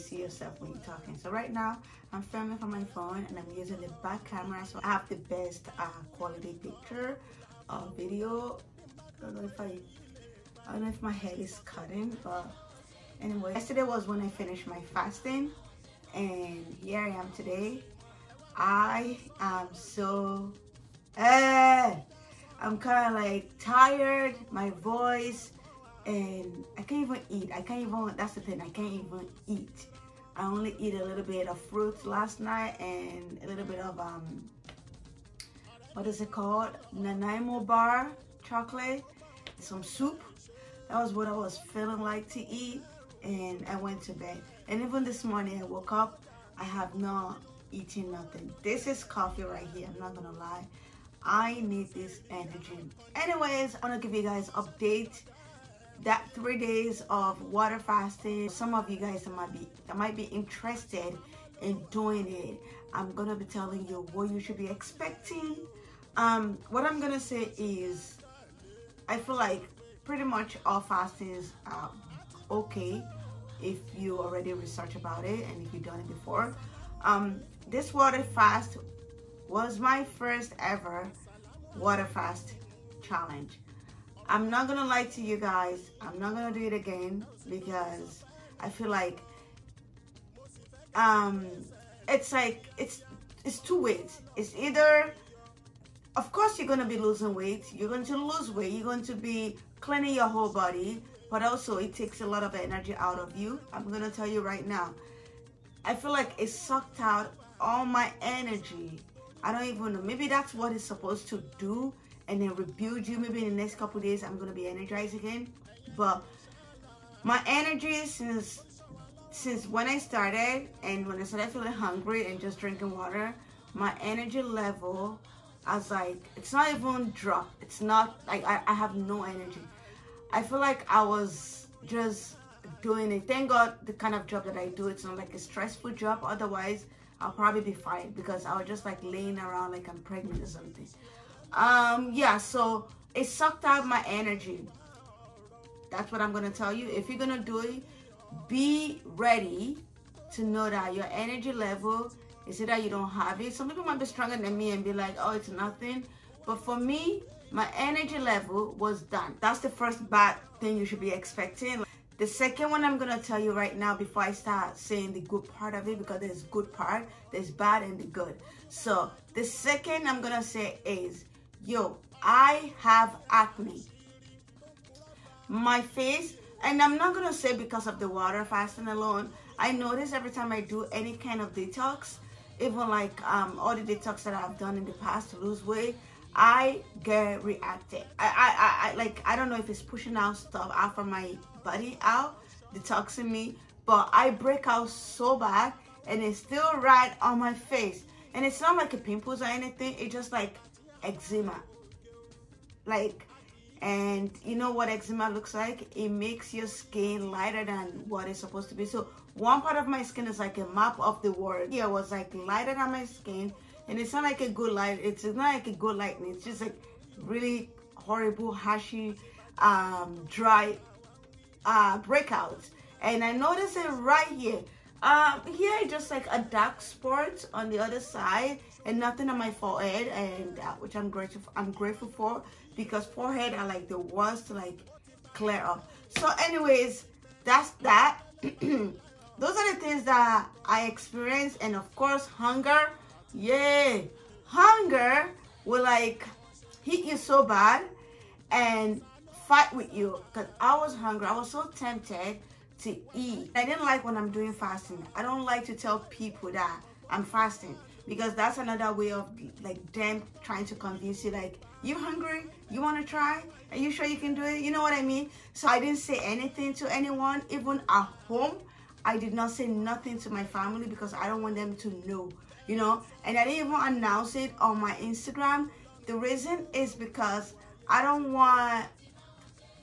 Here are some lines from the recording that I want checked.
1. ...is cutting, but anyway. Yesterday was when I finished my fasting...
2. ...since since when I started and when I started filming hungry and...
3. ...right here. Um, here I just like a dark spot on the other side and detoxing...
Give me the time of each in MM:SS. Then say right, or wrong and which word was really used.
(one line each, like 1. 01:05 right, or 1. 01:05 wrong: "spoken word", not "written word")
1. 00:11 right
2. 01:58 wrong: "feeling", not "filming"
3. 03:43 wrong: "nothing", not "detoxing".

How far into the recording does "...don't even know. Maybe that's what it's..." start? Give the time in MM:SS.
01:49.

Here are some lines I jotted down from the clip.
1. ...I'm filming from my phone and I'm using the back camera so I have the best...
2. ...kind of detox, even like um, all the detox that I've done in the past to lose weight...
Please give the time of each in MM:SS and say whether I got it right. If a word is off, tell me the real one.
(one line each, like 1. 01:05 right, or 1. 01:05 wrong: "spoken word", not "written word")
1. 00:02 right
2. 03:01 right.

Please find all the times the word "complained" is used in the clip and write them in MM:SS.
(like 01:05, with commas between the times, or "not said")
not said.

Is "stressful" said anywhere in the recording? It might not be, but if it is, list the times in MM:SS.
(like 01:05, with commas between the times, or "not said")
02:15.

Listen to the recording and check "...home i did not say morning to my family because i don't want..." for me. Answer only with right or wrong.
wrong.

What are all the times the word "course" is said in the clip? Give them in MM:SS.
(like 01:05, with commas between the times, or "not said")
01:36, 04:01.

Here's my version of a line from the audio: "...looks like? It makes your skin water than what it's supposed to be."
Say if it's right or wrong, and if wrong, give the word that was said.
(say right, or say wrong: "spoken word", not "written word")
wrong: "lighter", not "water".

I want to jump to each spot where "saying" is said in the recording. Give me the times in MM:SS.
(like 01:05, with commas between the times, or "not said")
02:44.